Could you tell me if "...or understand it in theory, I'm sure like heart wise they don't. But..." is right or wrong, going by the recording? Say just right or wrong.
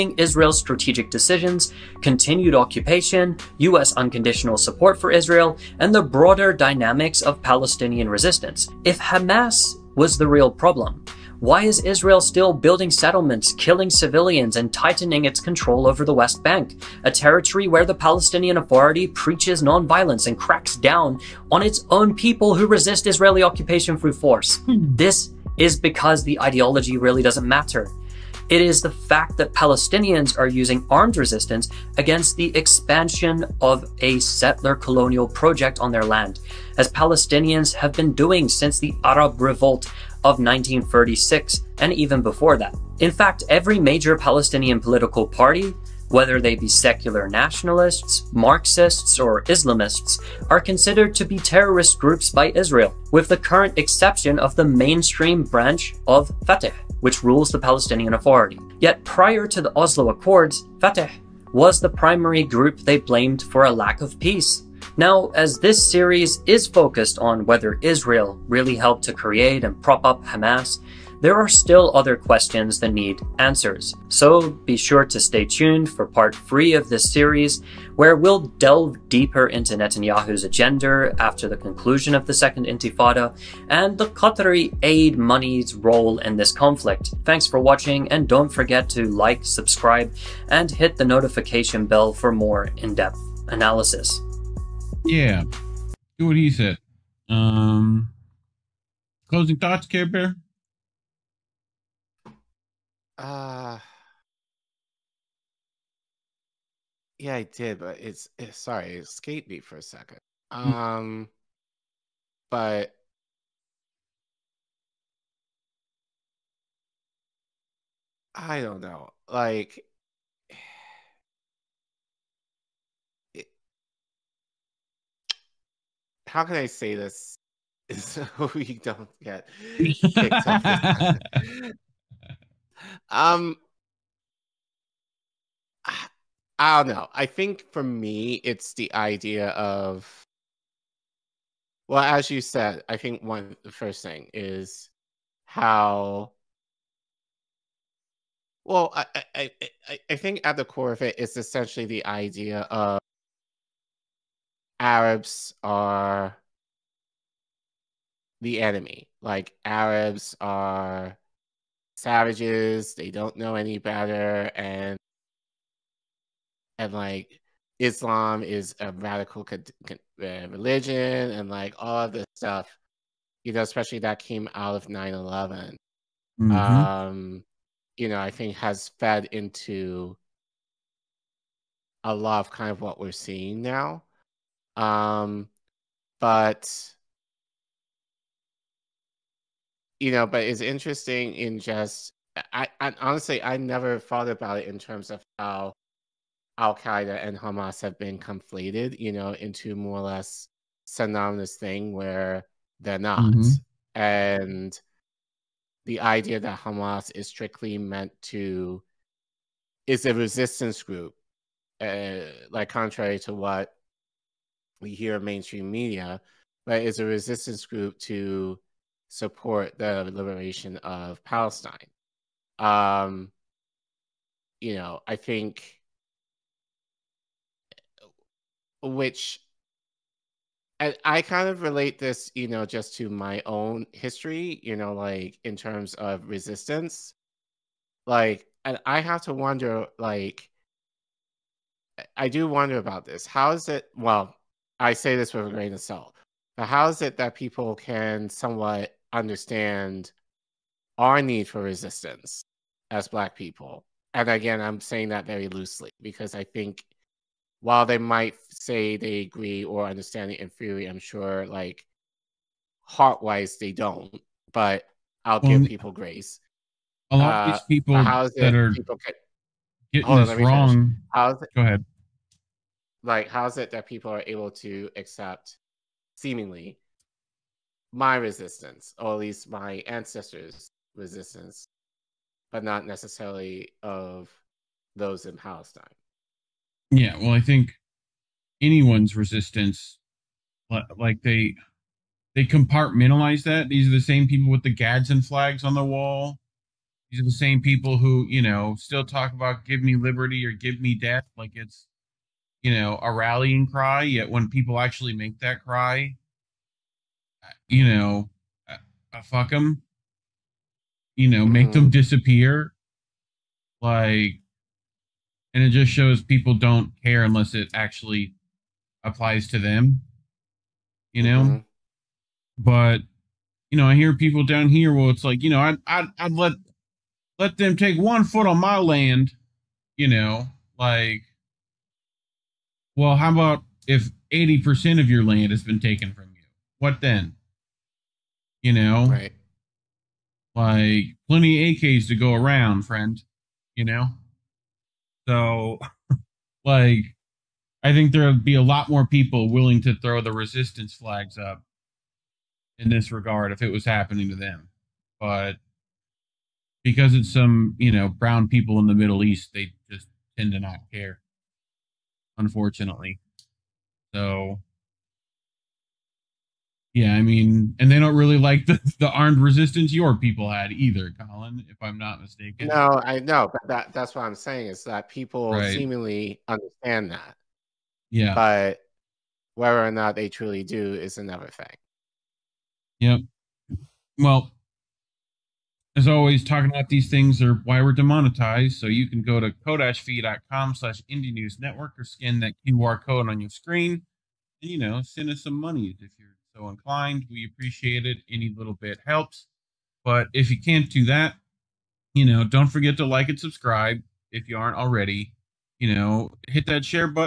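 right.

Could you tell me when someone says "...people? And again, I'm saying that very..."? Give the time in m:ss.
4:13.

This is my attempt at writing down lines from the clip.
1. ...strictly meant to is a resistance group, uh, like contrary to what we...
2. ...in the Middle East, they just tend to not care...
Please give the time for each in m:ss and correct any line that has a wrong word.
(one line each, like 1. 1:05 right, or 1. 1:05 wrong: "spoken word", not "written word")
1. 3:27 right
2. 5:58 right.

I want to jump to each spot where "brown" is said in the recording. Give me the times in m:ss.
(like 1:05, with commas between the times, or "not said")
5:58.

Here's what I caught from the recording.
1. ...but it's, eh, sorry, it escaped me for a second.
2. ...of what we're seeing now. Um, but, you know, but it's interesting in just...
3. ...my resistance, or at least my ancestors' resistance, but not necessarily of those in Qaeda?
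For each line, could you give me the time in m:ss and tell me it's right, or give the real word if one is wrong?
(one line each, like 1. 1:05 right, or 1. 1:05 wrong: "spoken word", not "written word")
1. 1:47 right
2. 3:02 right
3. 4:37 wrong: "Palestine", not "Qaeda".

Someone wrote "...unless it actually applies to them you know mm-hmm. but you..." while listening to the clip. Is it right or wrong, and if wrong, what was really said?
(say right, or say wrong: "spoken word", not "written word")
right.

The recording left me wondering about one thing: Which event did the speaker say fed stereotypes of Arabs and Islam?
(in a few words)
9/11.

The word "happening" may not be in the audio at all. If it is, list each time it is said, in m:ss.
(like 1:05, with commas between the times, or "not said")
5:53.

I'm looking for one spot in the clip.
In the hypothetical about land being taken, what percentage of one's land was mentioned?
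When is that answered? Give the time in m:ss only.
5:34.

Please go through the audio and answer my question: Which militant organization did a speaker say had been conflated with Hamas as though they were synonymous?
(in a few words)
Al Qaeda.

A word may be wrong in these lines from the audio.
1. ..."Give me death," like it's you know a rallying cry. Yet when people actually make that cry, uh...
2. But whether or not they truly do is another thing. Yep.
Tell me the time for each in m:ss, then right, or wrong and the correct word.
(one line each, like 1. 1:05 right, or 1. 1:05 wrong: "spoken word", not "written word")
1. 5:00 right
2. 6:18 right.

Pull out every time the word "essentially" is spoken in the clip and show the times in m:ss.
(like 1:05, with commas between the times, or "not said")
2:31.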